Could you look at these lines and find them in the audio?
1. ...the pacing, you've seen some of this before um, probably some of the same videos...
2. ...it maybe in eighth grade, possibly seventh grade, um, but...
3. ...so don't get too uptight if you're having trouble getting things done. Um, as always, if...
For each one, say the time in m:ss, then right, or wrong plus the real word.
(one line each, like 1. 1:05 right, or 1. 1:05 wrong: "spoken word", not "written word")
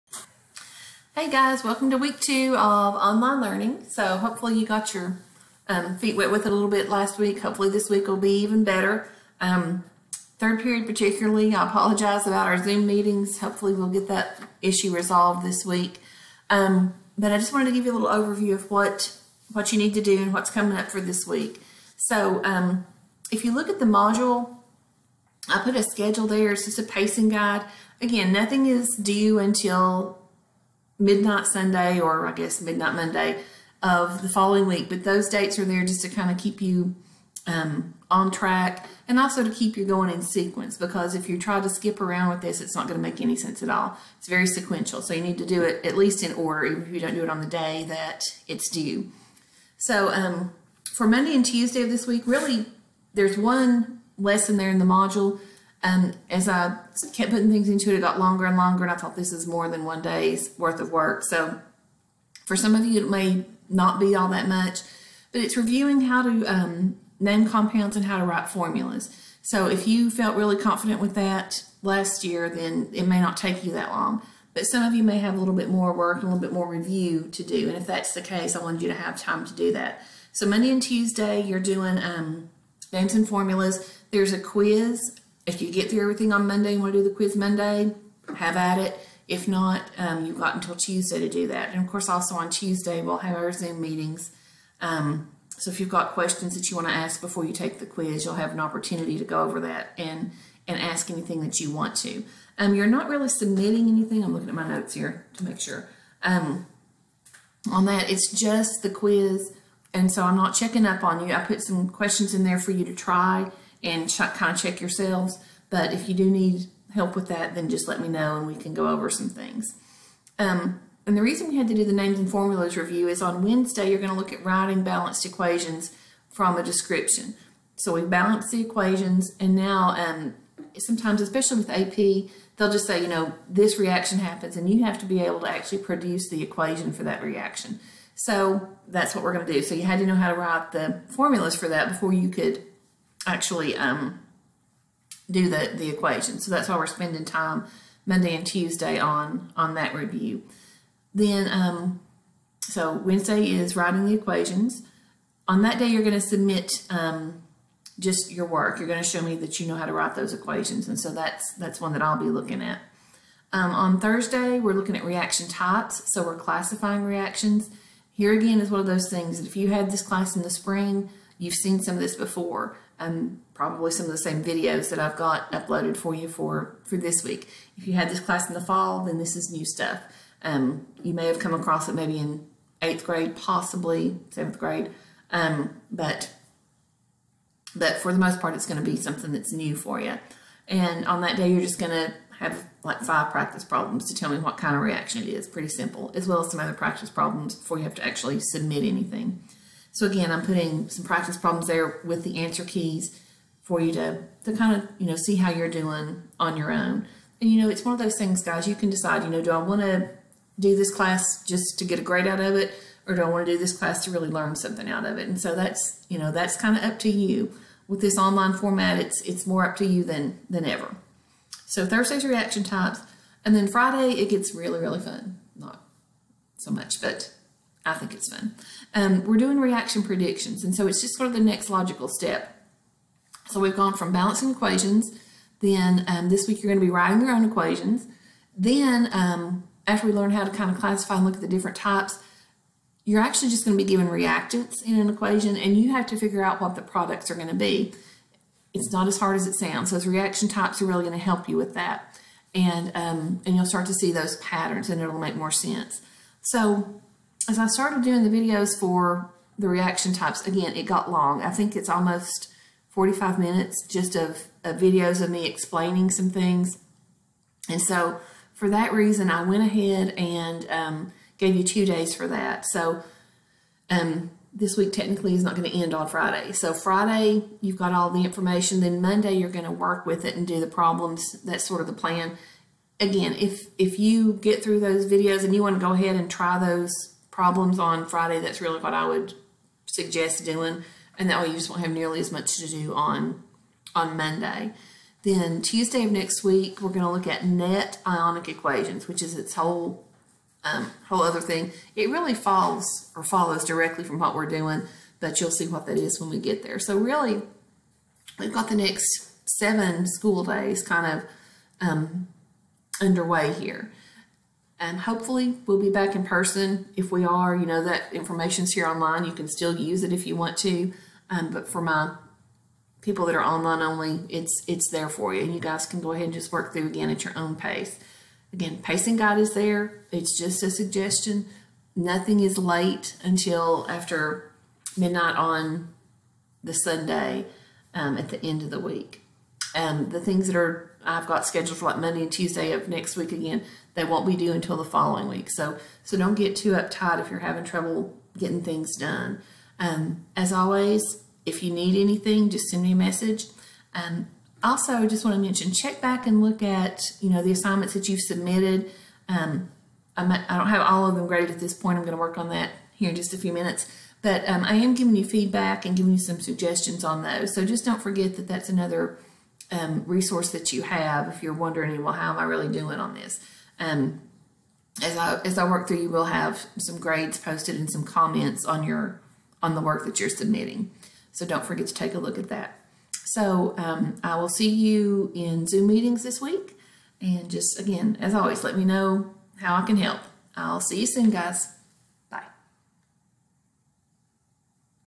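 1. 2:50 wrong: "spring", not "pacing"
2. 3:01 right
3. 5:46 right.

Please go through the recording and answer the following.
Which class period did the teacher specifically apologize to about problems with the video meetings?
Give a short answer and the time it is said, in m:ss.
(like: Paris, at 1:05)
Third period, at 0:10.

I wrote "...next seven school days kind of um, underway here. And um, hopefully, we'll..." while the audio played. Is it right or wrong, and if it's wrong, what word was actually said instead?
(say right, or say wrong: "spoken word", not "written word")
right.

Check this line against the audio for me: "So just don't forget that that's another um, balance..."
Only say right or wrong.
wrong.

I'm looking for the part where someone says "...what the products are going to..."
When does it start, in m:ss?
4:06.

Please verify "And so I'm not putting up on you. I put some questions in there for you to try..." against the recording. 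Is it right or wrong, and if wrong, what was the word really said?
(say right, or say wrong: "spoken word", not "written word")
wrong: "checking", not "putting".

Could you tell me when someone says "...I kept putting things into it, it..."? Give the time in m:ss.
0:56.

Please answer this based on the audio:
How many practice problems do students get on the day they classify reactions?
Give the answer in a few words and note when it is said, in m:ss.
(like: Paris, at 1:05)
5, at 3:13.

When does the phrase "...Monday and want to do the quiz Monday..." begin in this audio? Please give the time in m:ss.
1:26.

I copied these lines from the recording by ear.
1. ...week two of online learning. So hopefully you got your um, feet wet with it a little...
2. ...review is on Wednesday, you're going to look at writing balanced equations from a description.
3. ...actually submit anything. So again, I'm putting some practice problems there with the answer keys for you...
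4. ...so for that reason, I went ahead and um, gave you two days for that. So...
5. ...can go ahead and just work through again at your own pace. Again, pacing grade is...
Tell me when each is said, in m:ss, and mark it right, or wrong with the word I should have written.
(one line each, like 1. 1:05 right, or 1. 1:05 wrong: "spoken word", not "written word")
1. 0:01 right
2. 2:02 right
3. 3:18 right
4. 4:27 right
5. 5:25 wrong: "guide", not "grade".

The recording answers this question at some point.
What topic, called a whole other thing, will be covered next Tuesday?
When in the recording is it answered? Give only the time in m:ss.
4:57.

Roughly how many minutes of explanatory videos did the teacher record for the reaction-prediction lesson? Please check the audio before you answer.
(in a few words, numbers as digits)
45.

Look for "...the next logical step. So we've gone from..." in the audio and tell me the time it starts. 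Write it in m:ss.
3:51.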